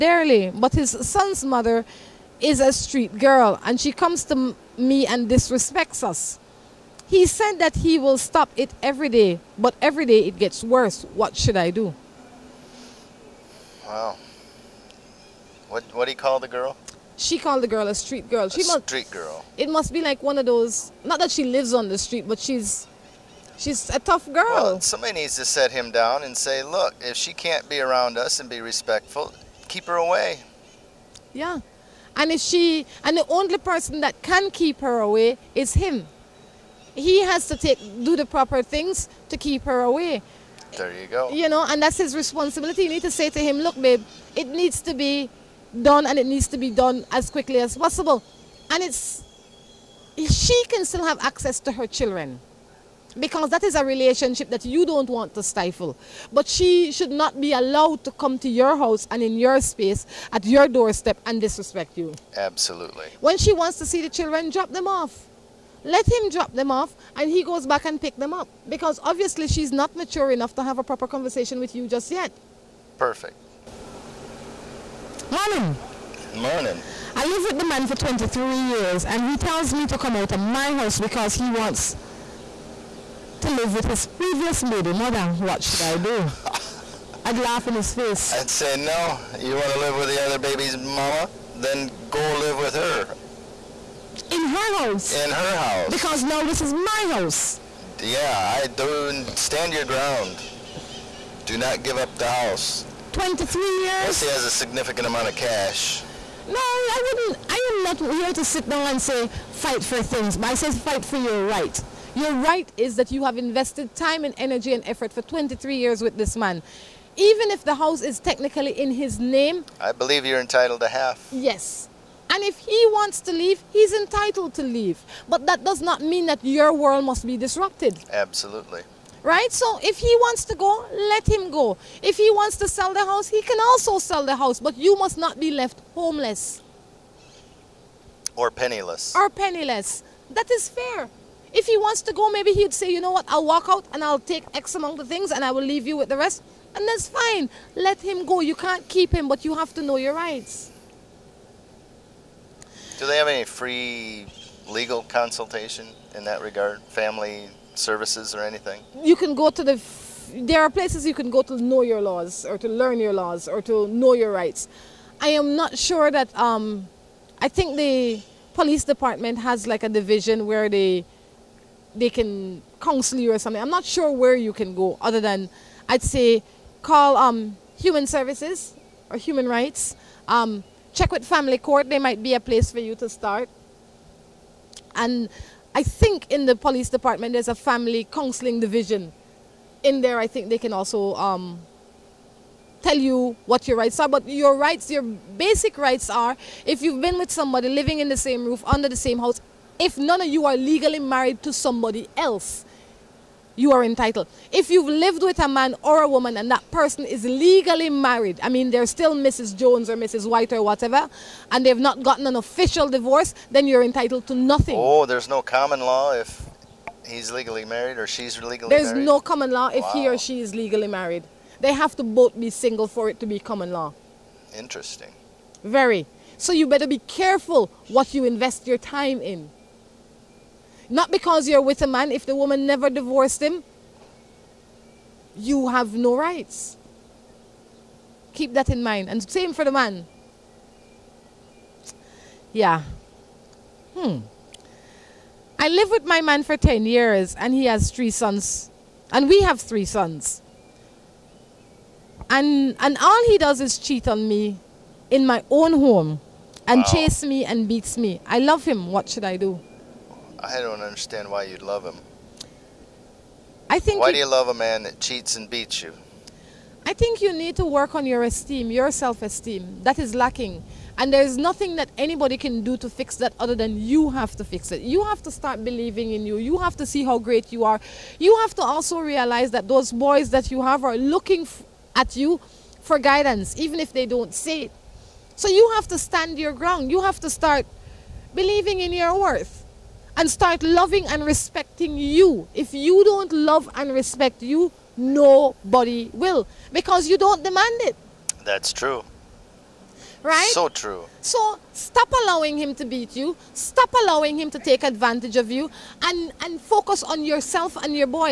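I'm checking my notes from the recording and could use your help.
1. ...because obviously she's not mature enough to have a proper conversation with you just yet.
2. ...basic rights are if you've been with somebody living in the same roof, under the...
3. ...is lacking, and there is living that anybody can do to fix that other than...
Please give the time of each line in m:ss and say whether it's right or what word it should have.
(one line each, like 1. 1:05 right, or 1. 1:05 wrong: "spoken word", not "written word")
1. 1:08 right
2. 3:15 right
3. 4:29 wrong: "nothing", not "living".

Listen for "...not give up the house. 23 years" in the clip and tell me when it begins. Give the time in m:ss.
1:41.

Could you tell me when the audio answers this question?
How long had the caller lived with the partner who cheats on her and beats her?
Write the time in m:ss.
4:06.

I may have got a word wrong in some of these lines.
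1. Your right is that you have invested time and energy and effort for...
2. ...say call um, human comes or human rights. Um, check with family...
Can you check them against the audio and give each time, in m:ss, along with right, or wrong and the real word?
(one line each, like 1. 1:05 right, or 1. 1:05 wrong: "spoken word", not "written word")
1. 1:52 right
2. 2:56 wrong: "services", not "comes".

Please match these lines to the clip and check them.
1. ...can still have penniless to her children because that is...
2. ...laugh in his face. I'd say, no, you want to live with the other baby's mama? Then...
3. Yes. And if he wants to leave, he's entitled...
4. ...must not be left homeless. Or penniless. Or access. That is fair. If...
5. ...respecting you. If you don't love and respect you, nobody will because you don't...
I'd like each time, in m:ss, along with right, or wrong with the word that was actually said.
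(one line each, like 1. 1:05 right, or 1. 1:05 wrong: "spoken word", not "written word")
1. 0:50 wrong: "access", not "penniless"
2. 1:27 right
3. 2:01 right
4. 2:14 wrong: "penniless", not "access"
5. 4:51 right.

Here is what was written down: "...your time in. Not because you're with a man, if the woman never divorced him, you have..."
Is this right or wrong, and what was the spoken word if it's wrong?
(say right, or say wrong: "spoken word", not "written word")
right.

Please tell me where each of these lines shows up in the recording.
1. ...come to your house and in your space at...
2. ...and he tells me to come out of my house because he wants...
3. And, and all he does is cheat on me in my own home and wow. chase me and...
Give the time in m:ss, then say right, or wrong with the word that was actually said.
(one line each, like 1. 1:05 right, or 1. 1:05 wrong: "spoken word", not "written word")
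1. 0:58 right
2. 1:19 right
3. 4:12 right.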